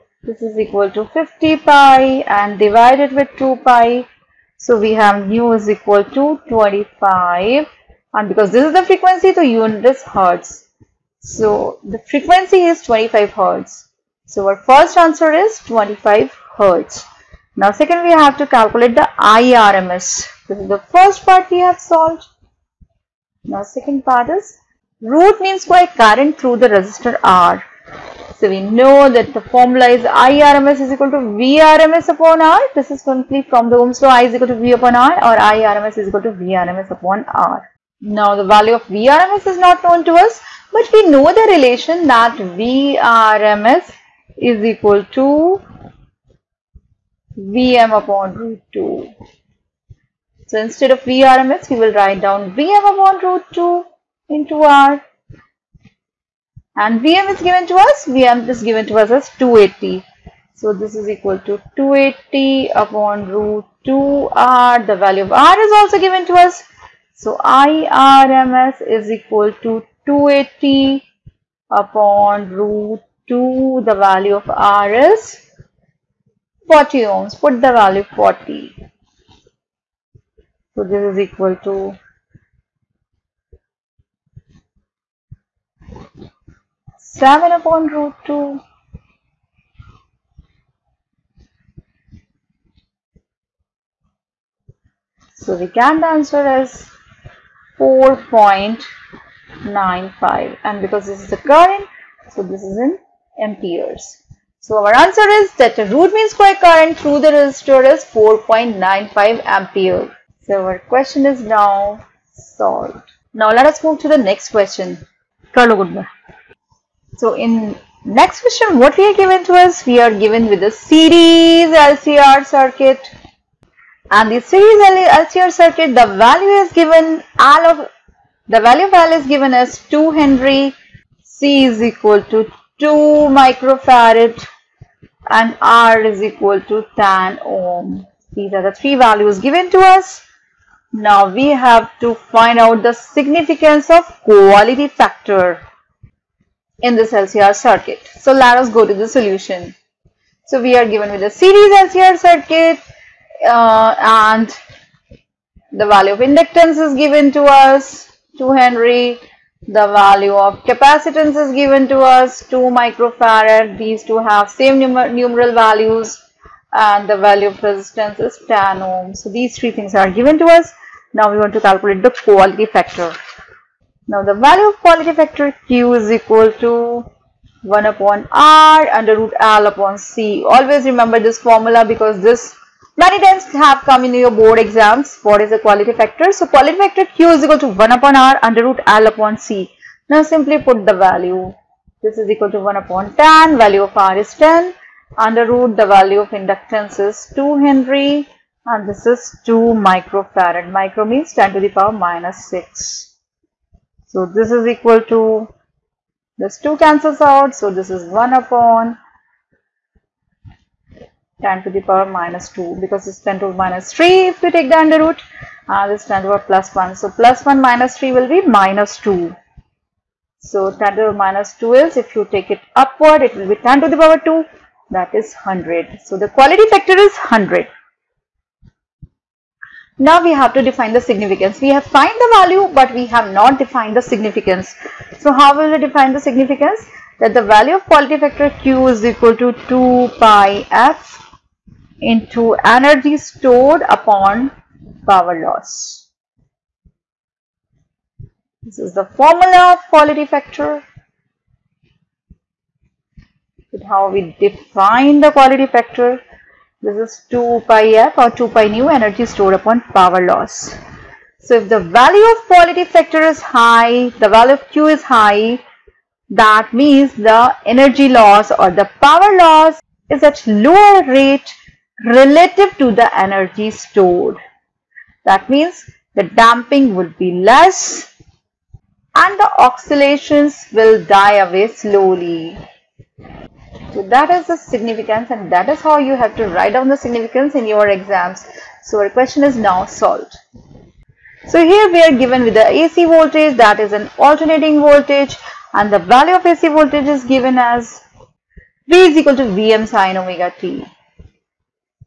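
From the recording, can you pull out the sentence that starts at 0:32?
This is simply from the Ohm's law I is equal to V upon R or IRMS is equal to VRMS upon R.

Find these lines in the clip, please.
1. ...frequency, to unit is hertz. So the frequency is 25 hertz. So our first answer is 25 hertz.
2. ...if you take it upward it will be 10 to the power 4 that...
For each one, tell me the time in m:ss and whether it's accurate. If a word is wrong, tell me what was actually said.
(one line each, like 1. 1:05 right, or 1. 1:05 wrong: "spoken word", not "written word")
1. 0:08 right
2. 3:41 wrong: "2", not "4".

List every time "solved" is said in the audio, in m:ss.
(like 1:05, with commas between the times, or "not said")
0:21, 1:52, 4:49.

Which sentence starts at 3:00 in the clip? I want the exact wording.
Always remember this formula because this many times have come in your board exams.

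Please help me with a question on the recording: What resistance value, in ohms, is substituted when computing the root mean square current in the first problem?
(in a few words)
40 ohms.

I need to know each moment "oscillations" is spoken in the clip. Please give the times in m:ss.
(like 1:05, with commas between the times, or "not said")
4:39.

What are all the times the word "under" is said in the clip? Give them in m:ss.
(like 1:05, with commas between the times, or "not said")
2:58, 3:08, 3:15, 3:34.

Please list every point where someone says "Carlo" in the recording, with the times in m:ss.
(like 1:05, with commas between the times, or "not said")
1:55.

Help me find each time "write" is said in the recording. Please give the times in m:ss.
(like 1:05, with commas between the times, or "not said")
0:51, 4:46.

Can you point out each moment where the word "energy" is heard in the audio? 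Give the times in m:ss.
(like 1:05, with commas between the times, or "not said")
4:02, 4:18, 4:27, 4:33.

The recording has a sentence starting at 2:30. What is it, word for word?
So we are given with a series LCR circuit uh, and the value of inductance is given to us 2 Henry.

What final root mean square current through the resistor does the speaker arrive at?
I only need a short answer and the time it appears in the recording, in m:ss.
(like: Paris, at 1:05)
4.95 ampere, at 1:48.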